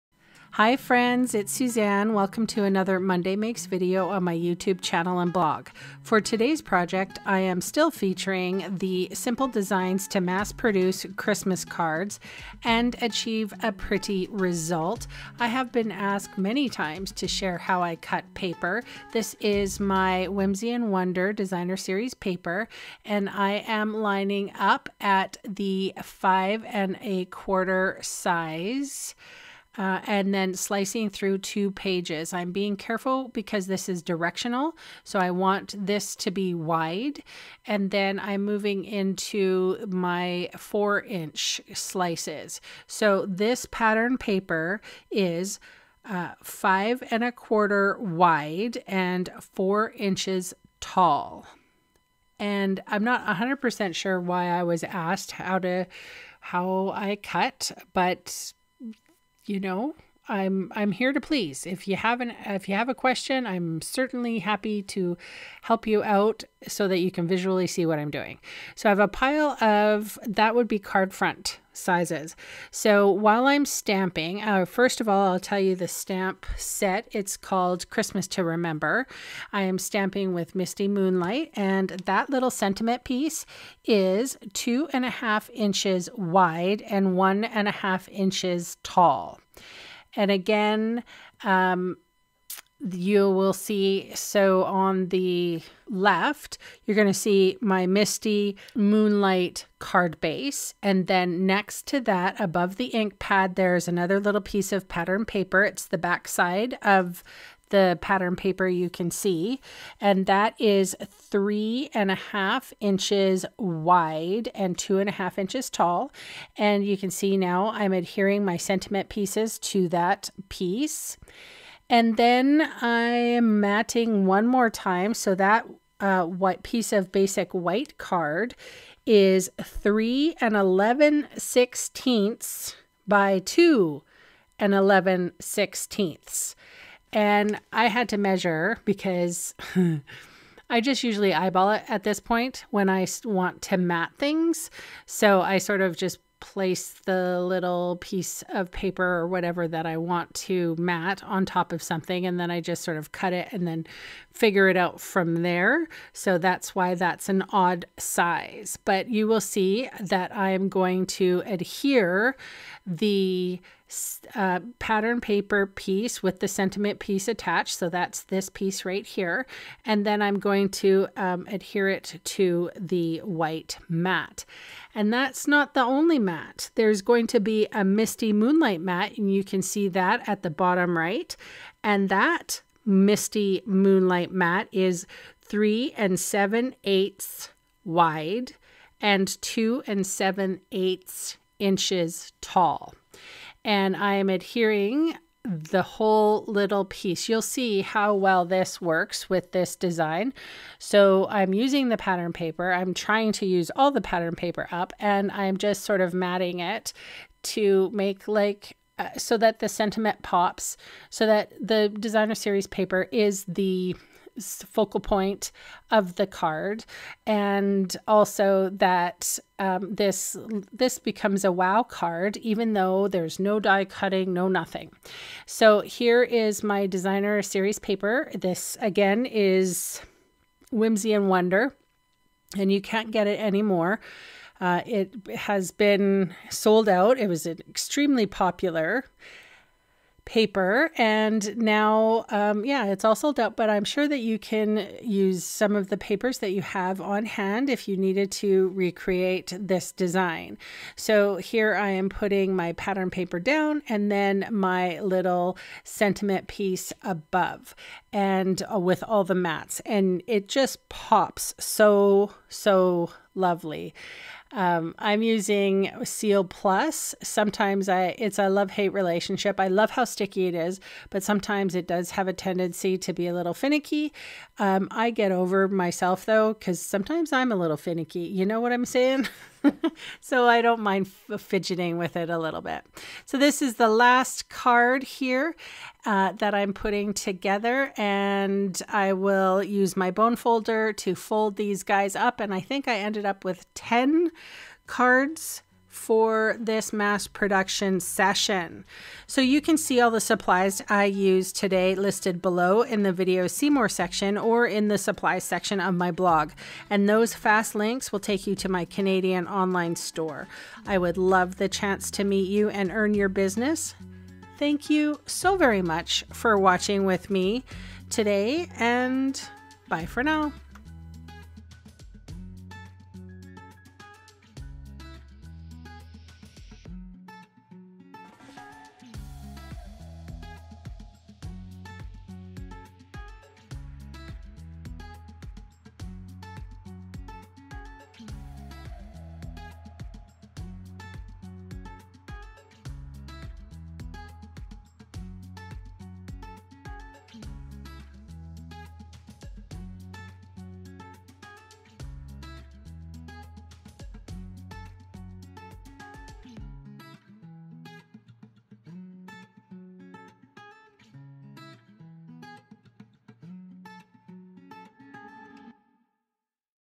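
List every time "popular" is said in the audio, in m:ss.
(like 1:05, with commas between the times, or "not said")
3:58.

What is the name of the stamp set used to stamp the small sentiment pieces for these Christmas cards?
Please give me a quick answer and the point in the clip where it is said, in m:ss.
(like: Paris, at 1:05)
Christmas to Remember, at 1:17.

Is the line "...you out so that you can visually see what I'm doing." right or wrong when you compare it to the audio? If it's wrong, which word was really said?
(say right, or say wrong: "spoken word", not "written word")
right.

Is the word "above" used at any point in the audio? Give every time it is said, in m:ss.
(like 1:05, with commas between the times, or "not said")
1:42, 4:17.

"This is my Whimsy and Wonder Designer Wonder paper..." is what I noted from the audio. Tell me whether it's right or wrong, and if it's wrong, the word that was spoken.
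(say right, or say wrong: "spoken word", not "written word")
wrong: "Series", not "Wonder".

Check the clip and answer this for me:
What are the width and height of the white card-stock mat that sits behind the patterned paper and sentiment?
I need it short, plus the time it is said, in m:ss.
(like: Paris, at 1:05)
3 11/16 by 2 11/16, at 2:09.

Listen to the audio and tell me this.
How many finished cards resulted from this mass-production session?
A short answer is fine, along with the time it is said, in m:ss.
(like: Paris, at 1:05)
10, at 4:53.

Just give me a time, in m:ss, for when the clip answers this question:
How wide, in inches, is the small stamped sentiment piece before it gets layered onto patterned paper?
1:24.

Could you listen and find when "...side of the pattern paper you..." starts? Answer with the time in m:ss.
1:46.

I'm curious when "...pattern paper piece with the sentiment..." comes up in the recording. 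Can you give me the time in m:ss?
2:44.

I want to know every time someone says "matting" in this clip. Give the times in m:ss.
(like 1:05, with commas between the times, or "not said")
2:03, 3:26.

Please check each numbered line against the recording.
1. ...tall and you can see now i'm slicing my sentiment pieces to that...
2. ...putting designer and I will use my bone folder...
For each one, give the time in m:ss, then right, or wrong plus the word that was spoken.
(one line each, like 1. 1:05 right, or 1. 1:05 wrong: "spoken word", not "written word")
1. 1:55 wrong: "adhering", not "slicing"
2. 4:46 wrong: "together", not "designer".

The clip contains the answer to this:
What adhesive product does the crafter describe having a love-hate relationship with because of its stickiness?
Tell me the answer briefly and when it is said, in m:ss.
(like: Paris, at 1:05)
Seal Plus, at 4:26.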